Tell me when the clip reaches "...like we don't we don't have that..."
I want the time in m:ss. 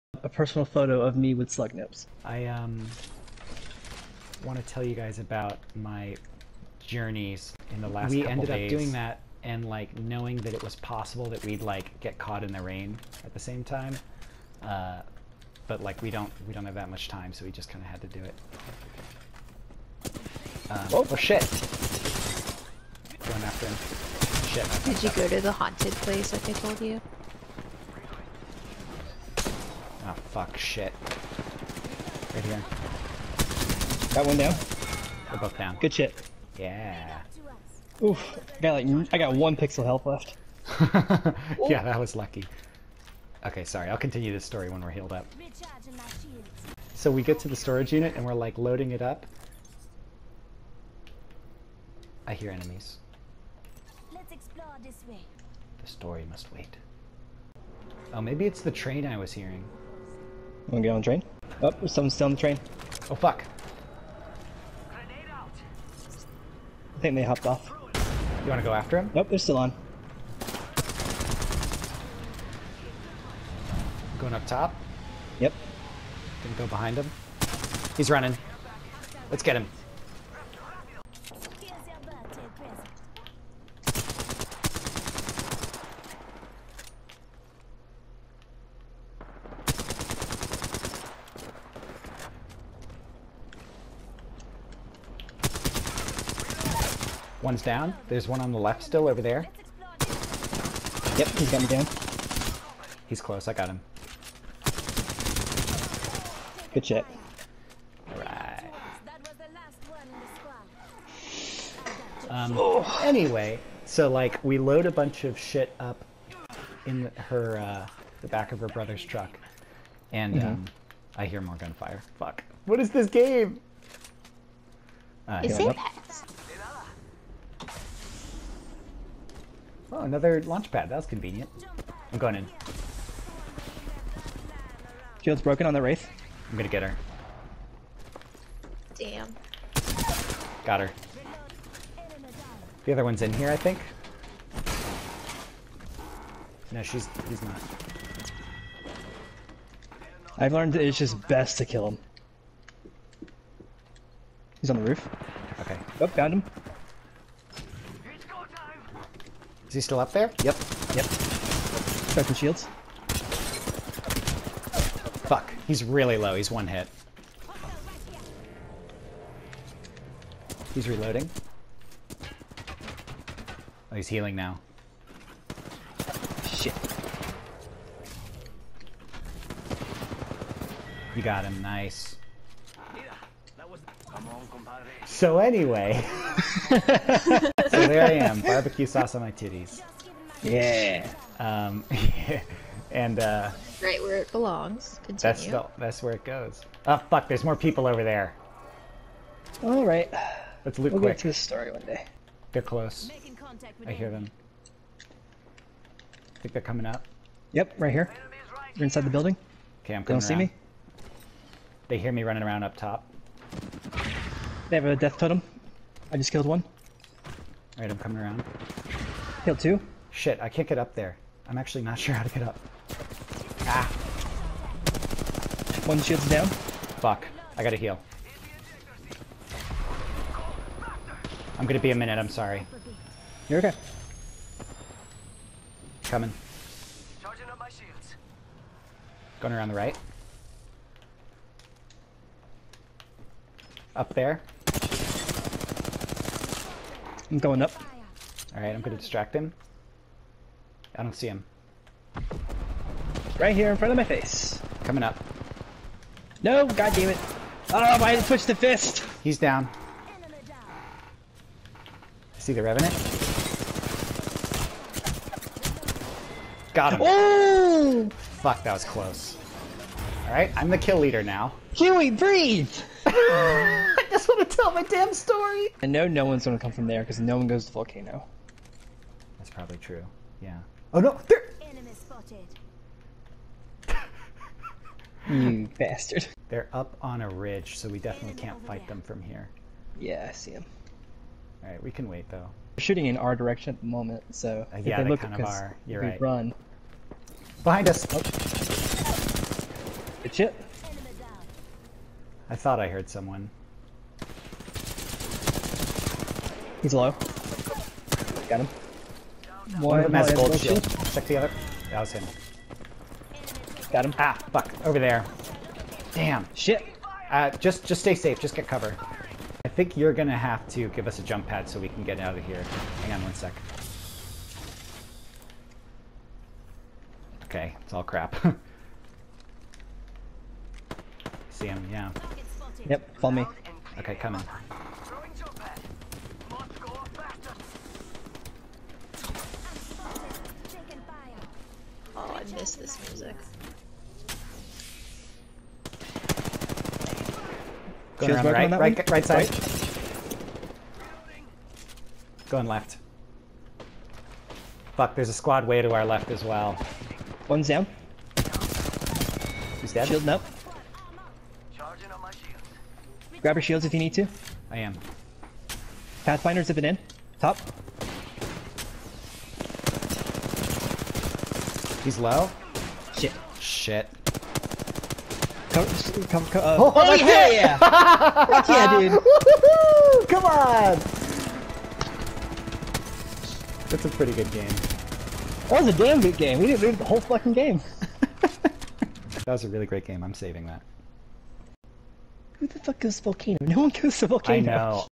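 0:15.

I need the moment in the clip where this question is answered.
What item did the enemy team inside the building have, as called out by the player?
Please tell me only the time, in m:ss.
3:34.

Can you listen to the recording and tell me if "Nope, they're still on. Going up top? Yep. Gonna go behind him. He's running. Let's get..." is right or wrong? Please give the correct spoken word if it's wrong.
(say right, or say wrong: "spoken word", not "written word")
right.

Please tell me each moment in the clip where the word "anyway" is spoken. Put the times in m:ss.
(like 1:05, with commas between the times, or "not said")
1:53, 3:05.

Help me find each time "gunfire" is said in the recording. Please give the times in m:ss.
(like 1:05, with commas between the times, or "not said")
2:01.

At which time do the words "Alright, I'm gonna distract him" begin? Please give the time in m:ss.
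4:08.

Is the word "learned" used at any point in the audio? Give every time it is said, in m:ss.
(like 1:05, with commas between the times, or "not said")
2:30.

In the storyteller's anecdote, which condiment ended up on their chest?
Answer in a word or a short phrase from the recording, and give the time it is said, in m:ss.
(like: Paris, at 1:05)
barbecue sauce, at 3:08.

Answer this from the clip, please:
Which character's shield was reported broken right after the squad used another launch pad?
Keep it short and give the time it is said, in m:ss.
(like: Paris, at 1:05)
Wraith, at 2:15.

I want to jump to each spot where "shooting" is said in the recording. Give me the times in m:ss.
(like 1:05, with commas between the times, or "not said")
4:52.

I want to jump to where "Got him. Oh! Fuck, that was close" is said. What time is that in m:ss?
4:26.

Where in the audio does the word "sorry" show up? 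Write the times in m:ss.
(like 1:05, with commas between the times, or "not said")
0:43, 3:52.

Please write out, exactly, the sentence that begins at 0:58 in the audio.
Oh, maybe it's the train I was hearing want gonna get on the train.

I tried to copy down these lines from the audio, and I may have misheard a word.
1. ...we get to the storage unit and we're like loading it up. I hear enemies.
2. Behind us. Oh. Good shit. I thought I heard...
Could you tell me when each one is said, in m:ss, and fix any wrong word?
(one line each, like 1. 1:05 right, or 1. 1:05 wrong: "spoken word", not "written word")
1. 0:47 right
2. 4:57 right.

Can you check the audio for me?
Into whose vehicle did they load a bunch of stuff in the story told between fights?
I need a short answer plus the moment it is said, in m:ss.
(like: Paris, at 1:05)
her brother's truck, at 1:58.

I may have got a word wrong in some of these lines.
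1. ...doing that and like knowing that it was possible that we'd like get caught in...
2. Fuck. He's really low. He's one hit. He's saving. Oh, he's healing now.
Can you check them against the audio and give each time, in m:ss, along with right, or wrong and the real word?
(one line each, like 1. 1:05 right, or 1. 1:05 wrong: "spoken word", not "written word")
1. 0:08 right
2. 2:45 wrong: "reloading", not "saving".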